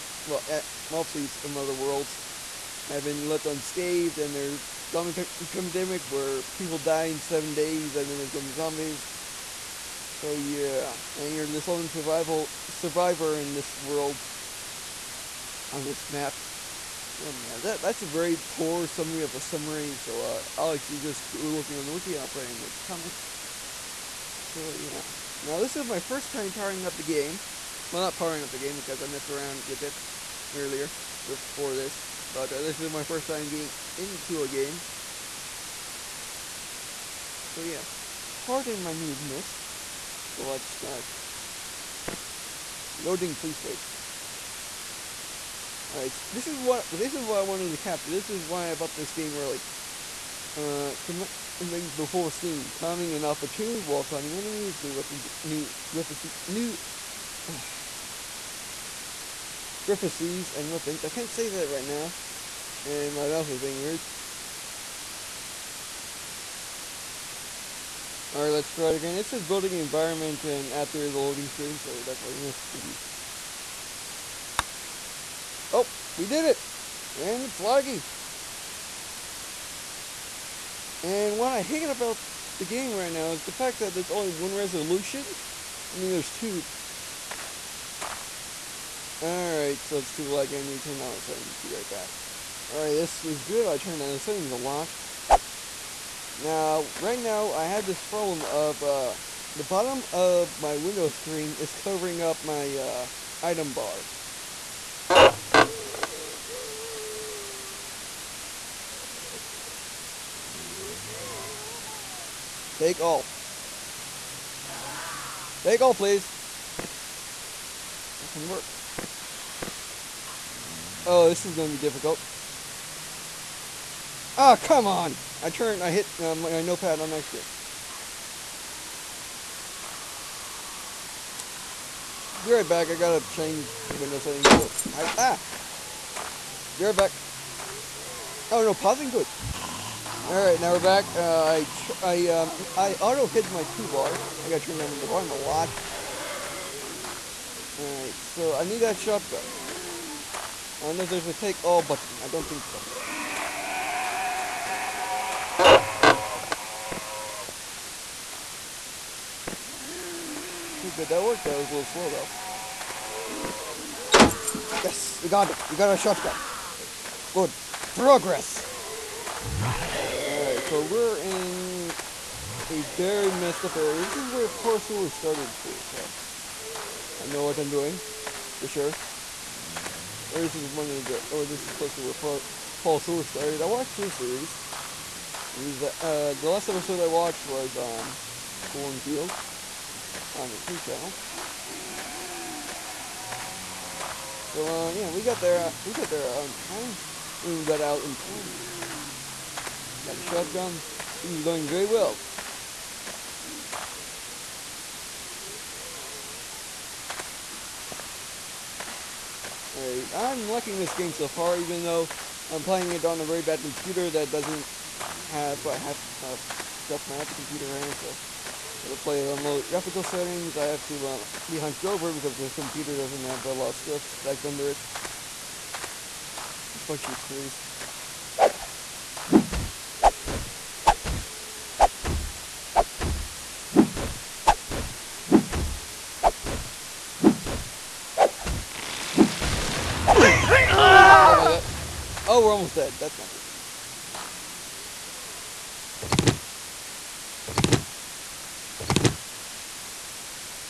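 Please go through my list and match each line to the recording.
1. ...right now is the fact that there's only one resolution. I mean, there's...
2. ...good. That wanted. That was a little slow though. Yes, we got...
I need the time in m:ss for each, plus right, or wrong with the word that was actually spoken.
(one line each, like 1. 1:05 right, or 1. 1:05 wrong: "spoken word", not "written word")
1. 1:22 right
2. 2:40 wrong: "worked", not "wanted".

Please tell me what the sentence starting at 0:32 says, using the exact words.
But uh, this is my first time getting into a game.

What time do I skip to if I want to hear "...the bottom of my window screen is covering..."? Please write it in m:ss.
1:39.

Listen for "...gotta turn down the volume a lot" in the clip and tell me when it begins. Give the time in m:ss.
2:24.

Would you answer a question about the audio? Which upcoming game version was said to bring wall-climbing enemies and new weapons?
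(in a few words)
Alpha 2.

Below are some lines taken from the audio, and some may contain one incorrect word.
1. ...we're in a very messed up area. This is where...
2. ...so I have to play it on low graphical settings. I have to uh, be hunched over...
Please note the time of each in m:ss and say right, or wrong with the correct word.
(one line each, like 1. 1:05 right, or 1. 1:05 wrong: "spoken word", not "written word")
1. 2:50 right
2. 3:37 right.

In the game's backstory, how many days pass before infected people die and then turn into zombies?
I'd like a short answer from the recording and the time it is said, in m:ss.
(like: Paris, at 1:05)
7, at 0:07.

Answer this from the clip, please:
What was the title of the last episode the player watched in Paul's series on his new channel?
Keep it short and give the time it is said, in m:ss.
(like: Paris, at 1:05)
Cornfield, at 3:08.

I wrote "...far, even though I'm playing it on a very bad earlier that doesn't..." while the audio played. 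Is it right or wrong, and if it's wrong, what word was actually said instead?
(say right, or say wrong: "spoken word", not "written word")
wrong: "computer", not "earlier".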